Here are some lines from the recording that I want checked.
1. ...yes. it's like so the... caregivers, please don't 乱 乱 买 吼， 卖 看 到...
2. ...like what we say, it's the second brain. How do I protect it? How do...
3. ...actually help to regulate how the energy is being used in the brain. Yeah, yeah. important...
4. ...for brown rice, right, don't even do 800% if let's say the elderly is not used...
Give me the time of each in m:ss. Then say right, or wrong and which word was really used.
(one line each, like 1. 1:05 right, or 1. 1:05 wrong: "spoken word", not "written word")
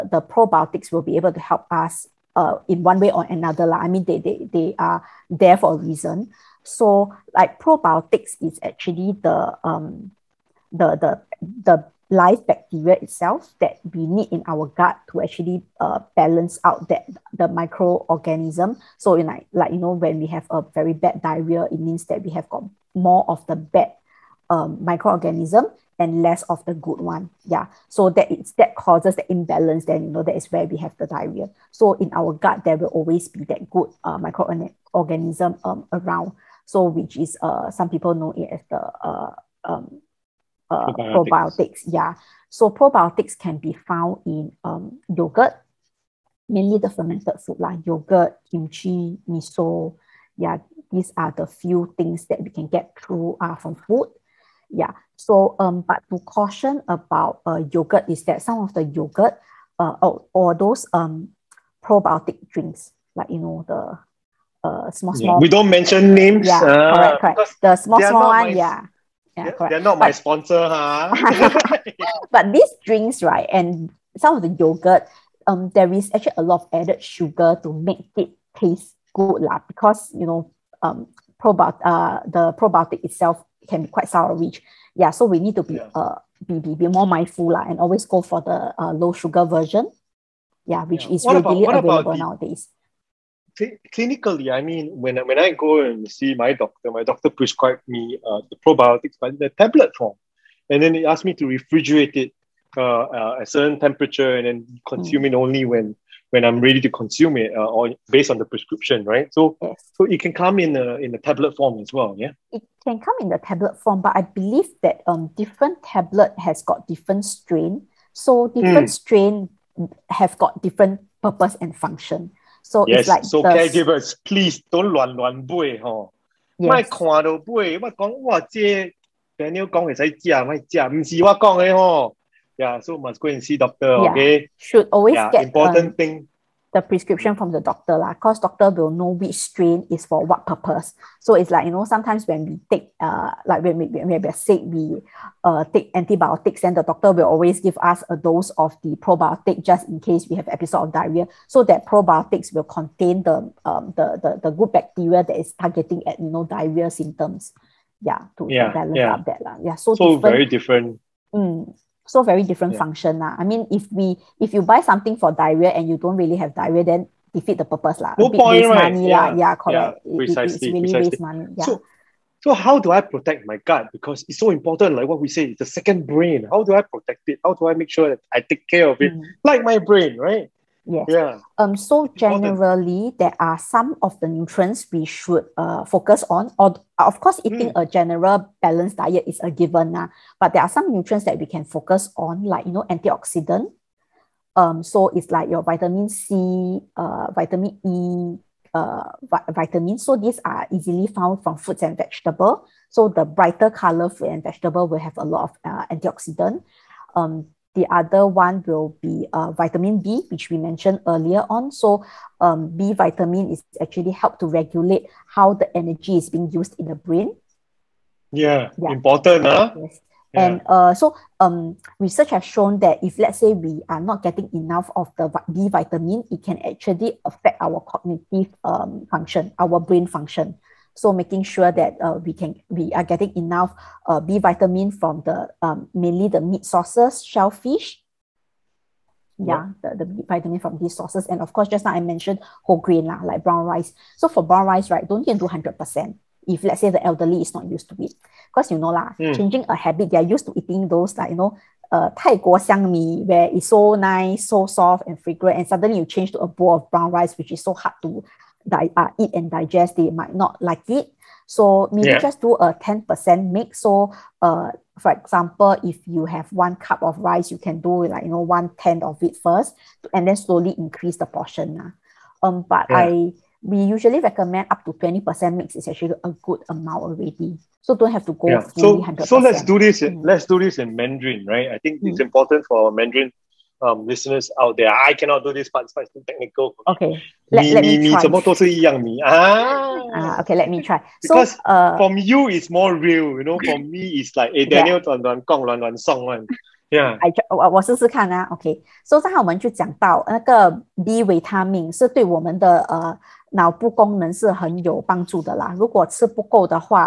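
1. 2:02 right
2. 2:54 right
3. 3:33 right
4. 4:04 wrong: "100", not "800".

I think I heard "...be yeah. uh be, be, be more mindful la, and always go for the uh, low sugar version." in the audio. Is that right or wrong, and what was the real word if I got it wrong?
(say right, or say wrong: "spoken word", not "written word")
right.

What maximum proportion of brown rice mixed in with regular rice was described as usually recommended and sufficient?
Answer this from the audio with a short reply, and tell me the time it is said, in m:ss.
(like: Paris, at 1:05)
20%, at 4:34.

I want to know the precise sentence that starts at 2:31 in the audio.
So that probiotics will contain the um the the, the good bacteria that is targeting at you know diarrhea symptoms.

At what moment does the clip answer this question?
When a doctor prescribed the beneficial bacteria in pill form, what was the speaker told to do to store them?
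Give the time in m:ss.
1:41.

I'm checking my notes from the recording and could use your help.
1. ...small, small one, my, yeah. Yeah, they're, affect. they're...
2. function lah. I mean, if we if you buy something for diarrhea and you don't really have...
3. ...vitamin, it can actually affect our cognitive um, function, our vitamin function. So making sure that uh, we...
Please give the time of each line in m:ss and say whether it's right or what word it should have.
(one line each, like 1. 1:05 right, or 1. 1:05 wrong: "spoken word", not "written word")
1. 1:07 wrong: "correct", not "affect"
2. 2:42 right
3. 3:45 wrong: "brain", not "vitamin".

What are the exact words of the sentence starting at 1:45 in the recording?
only when when I'm ready to consume it uh, or based on the prescription, right?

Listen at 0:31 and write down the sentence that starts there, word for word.
So in our gut, there will always be that good uh, microorganism um, around.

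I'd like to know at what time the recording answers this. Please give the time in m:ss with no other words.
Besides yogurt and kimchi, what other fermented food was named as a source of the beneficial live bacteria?
0:49.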